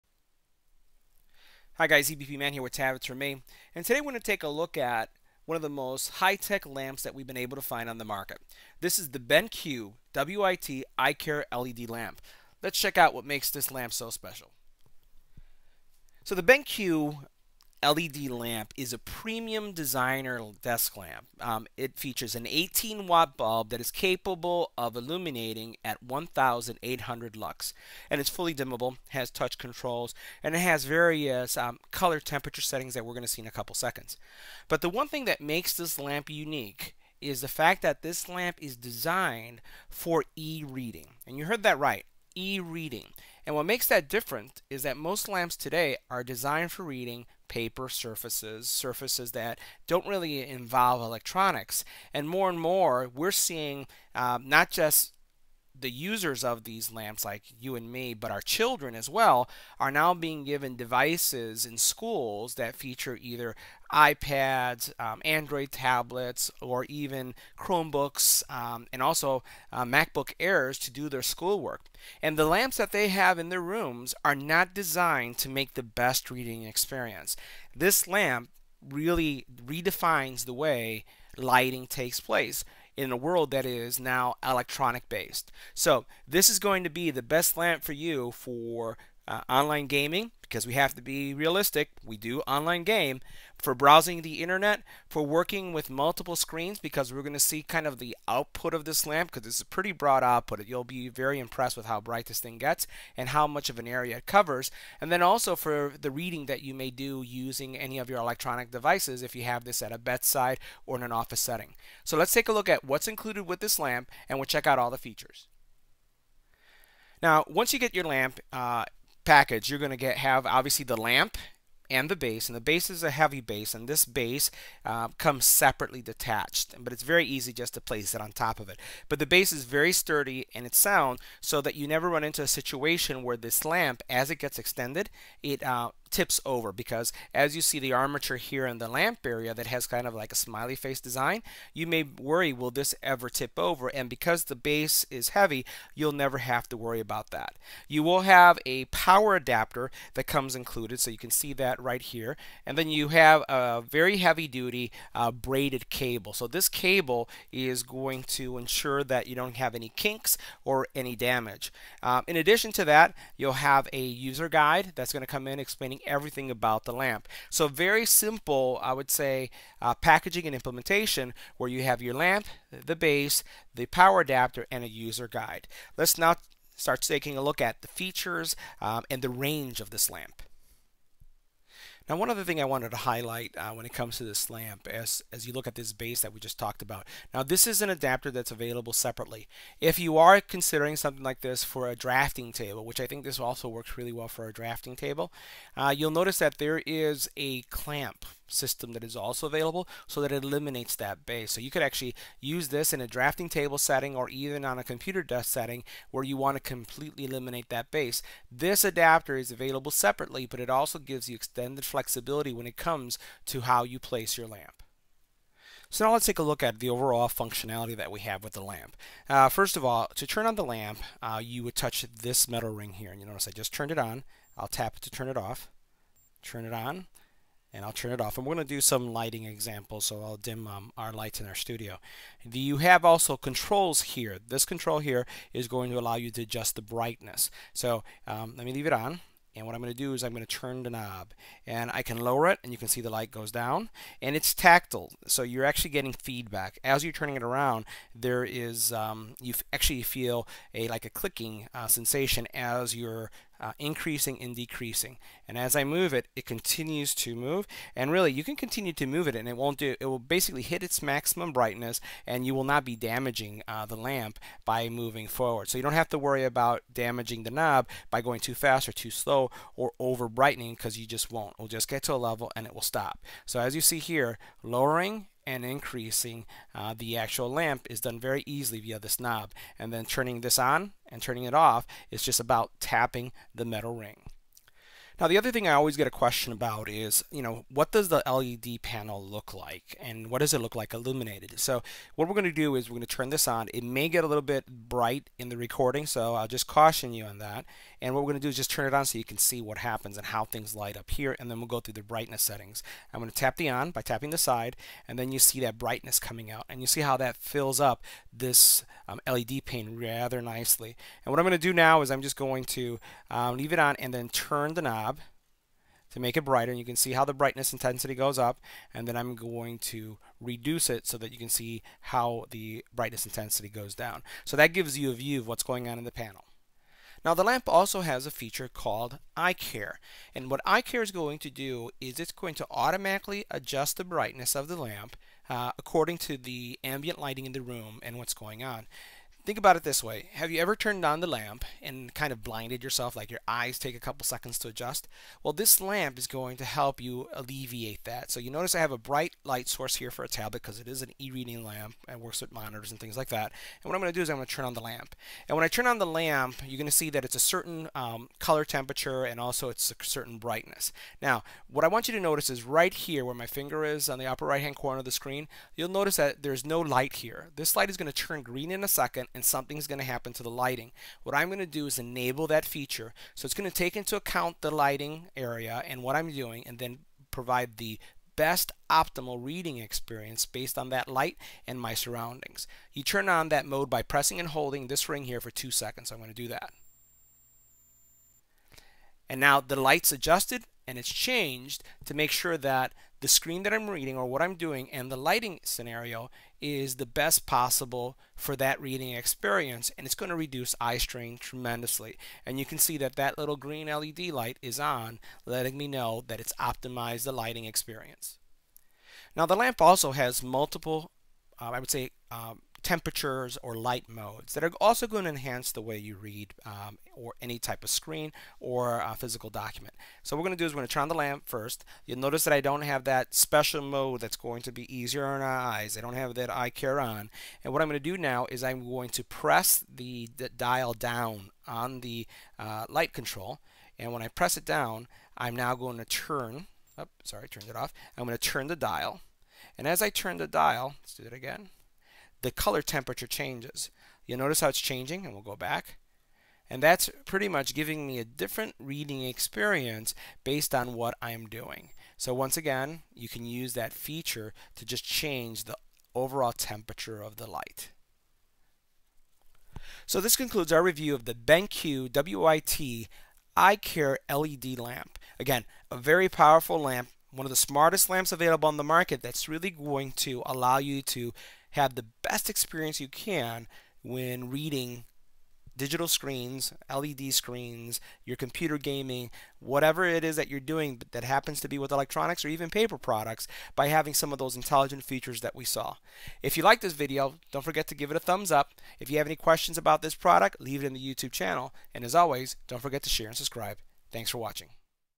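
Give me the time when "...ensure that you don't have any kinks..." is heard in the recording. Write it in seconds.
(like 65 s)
158 s.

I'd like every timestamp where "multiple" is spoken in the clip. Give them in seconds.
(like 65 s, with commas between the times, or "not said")
95 s, 410 s.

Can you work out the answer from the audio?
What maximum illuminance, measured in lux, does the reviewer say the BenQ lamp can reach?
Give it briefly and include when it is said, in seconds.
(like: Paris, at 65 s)
1800 lux, at 26 s.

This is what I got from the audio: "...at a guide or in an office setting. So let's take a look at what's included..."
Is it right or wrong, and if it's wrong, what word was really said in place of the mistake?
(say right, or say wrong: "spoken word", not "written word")
wrong: "bedside", not "guide".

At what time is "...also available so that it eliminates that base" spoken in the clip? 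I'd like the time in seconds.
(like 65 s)
199 s.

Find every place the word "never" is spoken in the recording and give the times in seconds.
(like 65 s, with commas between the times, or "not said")
131 s, 146 s.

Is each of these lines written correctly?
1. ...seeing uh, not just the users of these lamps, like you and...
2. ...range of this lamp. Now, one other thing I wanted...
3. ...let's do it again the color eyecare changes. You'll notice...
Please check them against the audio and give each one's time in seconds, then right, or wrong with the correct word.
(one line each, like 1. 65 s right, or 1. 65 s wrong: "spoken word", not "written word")
1. 53 s right
2. 179 s right
3. 441 s wrong: "temperature", not "eyecare".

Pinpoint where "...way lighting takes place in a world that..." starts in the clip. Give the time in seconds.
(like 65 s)
80 s.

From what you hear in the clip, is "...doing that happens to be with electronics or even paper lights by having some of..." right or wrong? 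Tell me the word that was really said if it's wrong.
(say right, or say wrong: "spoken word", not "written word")
wrong: "products", not "lights".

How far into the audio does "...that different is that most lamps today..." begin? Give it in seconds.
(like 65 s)
43 s.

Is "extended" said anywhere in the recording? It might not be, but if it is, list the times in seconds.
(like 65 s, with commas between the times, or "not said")
134 s, 211 s.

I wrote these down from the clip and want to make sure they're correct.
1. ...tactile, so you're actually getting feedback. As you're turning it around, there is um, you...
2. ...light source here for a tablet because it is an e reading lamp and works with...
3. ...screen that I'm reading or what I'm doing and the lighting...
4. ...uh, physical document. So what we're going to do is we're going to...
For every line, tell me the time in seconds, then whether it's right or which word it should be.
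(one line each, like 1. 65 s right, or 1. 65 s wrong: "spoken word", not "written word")
1. 244 s right
2. 349 s right
3. 393 s right
4. 419 s right.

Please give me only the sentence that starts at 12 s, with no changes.
Let's check out what makes this lamp so special.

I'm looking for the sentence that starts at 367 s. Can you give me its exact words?
This light is going to turn green in a second and something's going to happen to the lighting.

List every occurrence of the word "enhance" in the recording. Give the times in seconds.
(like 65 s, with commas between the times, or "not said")
415 s.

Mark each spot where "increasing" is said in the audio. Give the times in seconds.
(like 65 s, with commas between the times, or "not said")
253 s, 275 s.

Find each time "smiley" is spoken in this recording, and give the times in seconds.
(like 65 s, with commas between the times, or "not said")
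140 s.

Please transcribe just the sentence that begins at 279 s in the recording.
And then turning this on and turning it off is just about tapping the metal ring.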